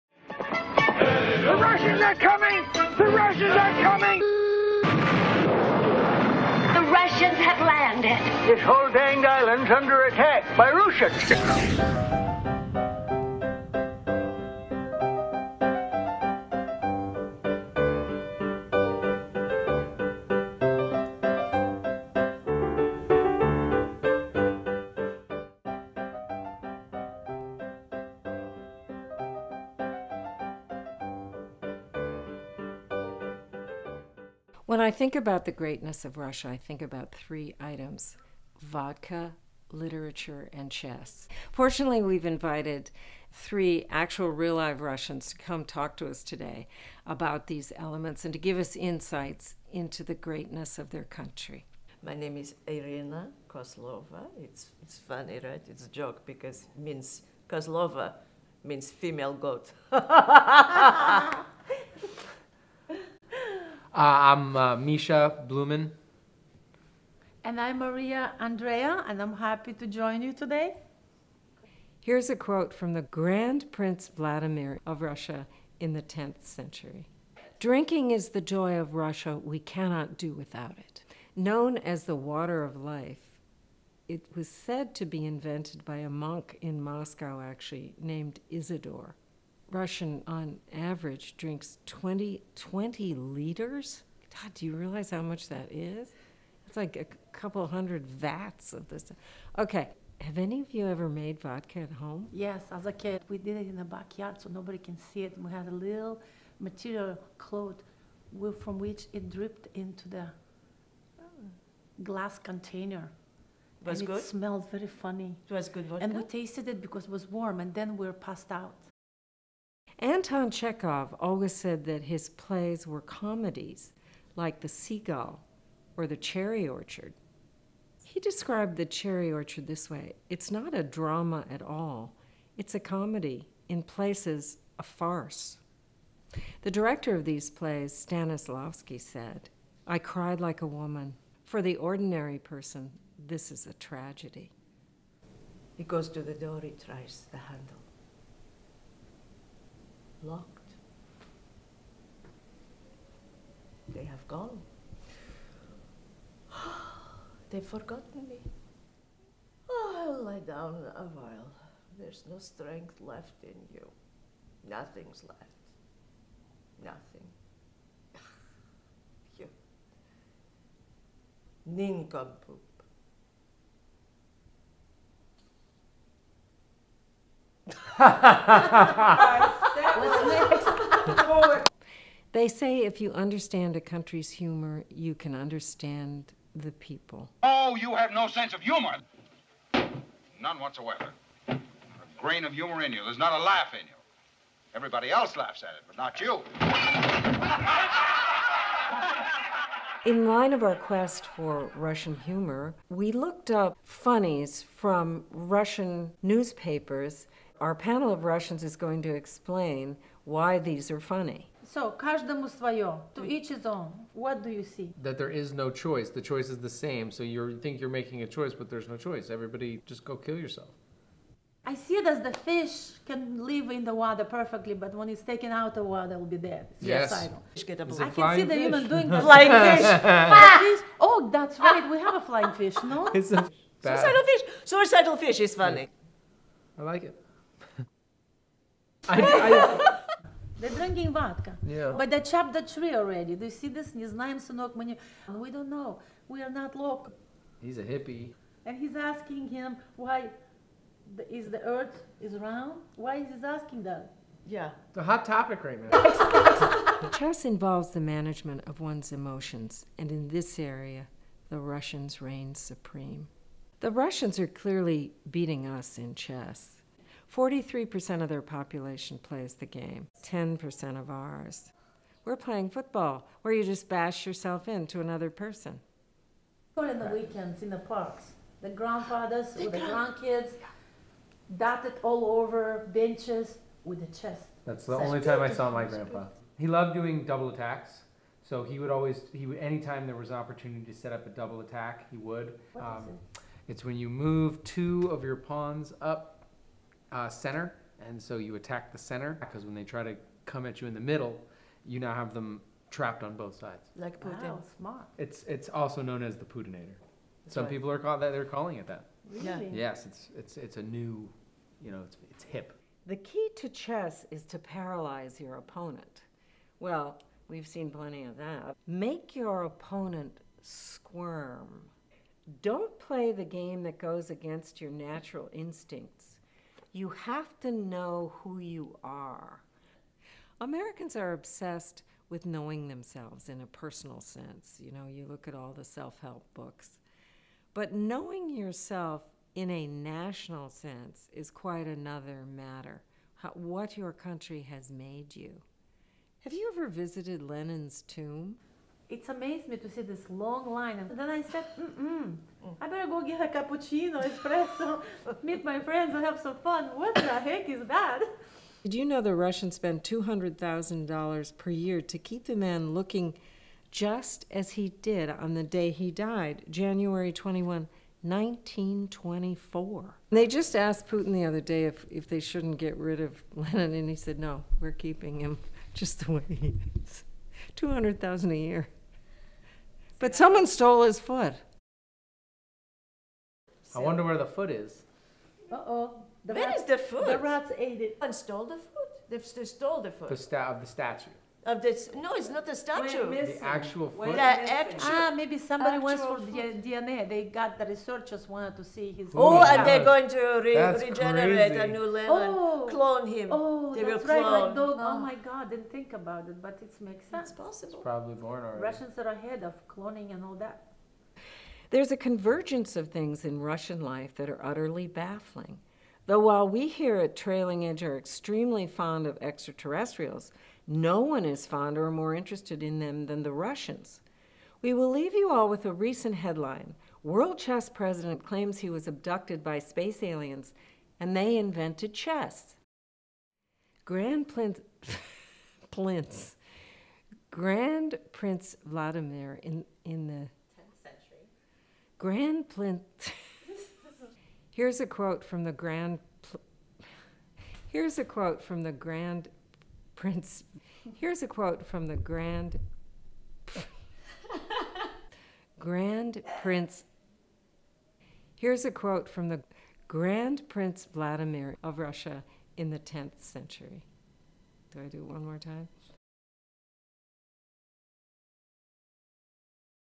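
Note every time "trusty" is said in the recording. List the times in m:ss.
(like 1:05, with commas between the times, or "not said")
not said.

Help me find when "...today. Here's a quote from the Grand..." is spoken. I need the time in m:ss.
1:10.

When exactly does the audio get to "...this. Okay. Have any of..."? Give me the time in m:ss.
1:38.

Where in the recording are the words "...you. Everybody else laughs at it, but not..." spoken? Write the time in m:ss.
3:13.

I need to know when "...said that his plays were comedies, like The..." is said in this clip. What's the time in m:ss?
2:01.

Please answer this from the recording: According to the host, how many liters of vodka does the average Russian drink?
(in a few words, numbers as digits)
20.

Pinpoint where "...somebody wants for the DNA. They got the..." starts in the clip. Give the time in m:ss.
6:35.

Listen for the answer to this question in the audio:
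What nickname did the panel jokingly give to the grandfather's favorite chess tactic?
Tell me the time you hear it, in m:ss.
5:06.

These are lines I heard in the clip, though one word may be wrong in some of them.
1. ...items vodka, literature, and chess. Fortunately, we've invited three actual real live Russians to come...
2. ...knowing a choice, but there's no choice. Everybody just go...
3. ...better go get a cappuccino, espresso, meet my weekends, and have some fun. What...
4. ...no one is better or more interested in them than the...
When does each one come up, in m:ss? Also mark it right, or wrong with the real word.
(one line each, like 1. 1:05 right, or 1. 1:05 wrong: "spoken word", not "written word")
1. 0:37 right
2. 3:38 wrong: "making", not "knowing"
3. 5:52 wrong: "friends", not "weekends"
4. 7:00 wrong: "fonder", not "better".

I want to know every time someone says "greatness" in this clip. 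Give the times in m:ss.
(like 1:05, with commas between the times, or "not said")
0:35, 0:50.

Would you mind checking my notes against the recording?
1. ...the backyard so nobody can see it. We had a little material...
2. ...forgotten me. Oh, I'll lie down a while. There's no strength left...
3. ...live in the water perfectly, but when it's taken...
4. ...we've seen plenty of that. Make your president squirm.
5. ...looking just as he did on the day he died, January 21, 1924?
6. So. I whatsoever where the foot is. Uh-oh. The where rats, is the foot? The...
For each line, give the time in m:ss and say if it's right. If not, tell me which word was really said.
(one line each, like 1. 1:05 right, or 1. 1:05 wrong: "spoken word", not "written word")
1. 1:43 right
2. 2:37 right
3. 3:43 right
4. 5:17 wrong: "opponent", not "president"
5. 6:02 right
6. 6:23 wrong: "wonder", not "whatsoever".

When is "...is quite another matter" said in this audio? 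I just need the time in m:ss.
5:41.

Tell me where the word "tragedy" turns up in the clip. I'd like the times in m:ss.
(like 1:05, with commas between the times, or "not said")
2:23.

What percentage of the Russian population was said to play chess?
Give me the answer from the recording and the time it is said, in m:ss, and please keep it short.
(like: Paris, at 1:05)
43%, at 4:27.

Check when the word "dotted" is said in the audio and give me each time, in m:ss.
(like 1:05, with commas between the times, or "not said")
4:41.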